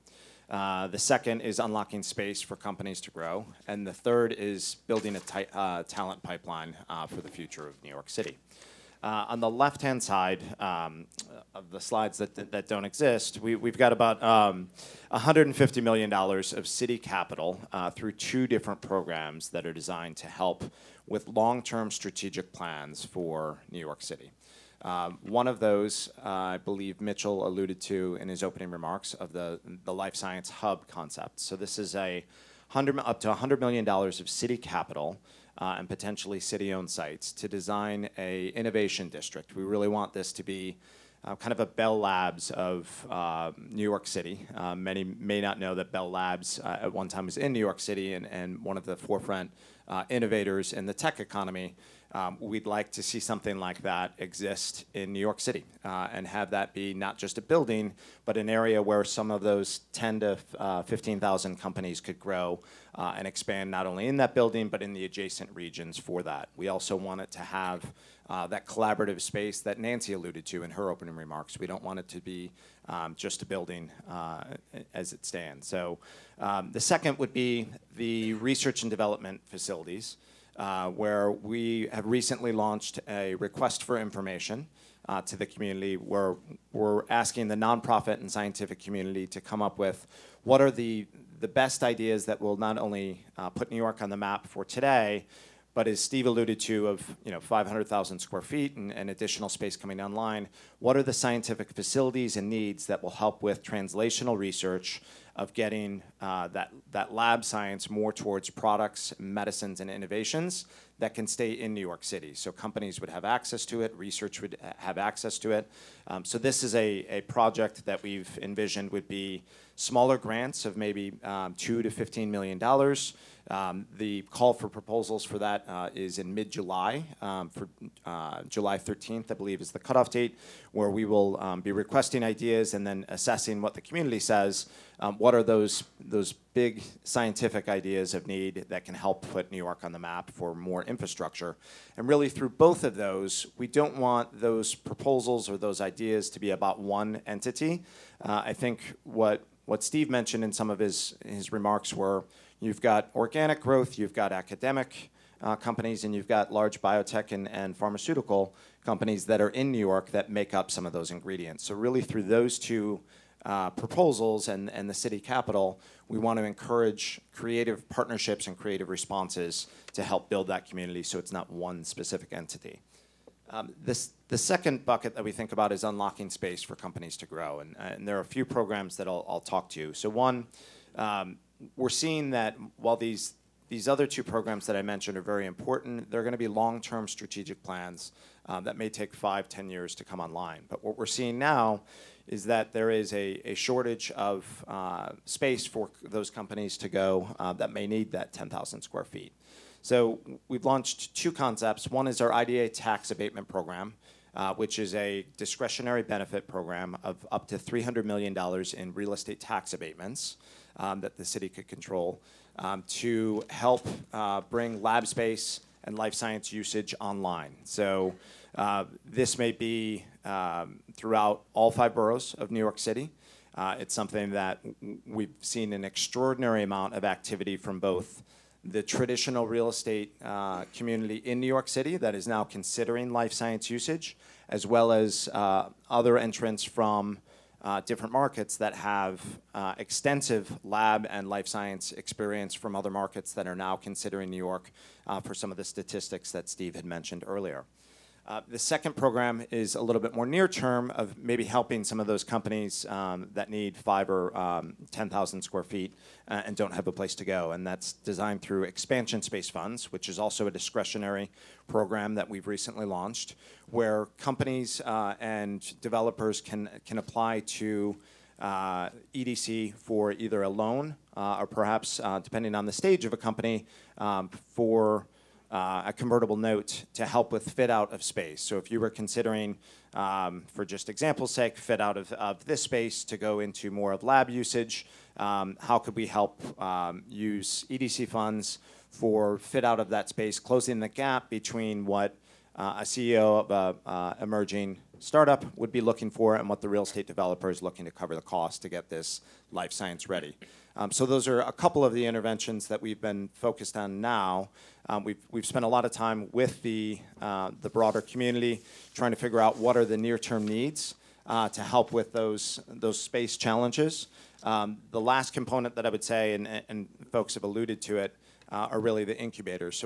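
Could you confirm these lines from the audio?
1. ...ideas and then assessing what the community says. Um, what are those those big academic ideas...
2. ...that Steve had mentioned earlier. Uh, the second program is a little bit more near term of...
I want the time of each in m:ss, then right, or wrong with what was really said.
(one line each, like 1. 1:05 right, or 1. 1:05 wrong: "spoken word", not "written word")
1. 2:12 wrong: "scientific", not "academic"
2. 4:06 right.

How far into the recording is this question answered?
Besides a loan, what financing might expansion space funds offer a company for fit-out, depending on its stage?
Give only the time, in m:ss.
4:35.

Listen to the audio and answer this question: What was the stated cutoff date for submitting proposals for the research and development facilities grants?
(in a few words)
July 13.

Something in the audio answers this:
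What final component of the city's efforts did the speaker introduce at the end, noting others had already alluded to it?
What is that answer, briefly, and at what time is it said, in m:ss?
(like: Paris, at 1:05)
Incubators, at 5:19.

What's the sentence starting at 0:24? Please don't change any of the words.
Um, one of those, uh, I believe Mitchell alluded to in his opening remarks of the, the life science hub concept.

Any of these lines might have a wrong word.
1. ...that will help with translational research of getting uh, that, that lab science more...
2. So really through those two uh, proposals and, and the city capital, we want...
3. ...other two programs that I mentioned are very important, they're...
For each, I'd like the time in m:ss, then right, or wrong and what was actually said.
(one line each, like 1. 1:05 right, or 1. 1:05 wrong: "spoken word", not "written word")
1. 1:42 right
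2. 2:41 right
3. 3:03 right.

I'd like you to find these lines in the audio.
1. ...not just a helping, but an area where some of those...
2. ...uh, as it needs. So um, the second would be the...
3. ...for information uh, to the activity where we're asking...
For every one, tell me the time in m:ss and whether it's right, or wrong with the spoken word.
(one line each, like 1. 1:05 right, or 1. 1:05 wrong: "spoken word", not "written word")
1. 0:56 wrong: "building", not "helping"
2. 1:14 wrong: "stands", not "needs"
3. 1:23 wrong: "community", not "activity".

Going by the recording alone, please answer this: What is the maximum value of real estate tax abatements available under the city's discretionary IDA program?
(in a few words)
$300 million.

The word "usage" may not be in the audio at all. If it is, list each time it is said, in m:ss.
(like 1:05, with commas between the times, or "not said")
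3:36, 3:53, 4:44.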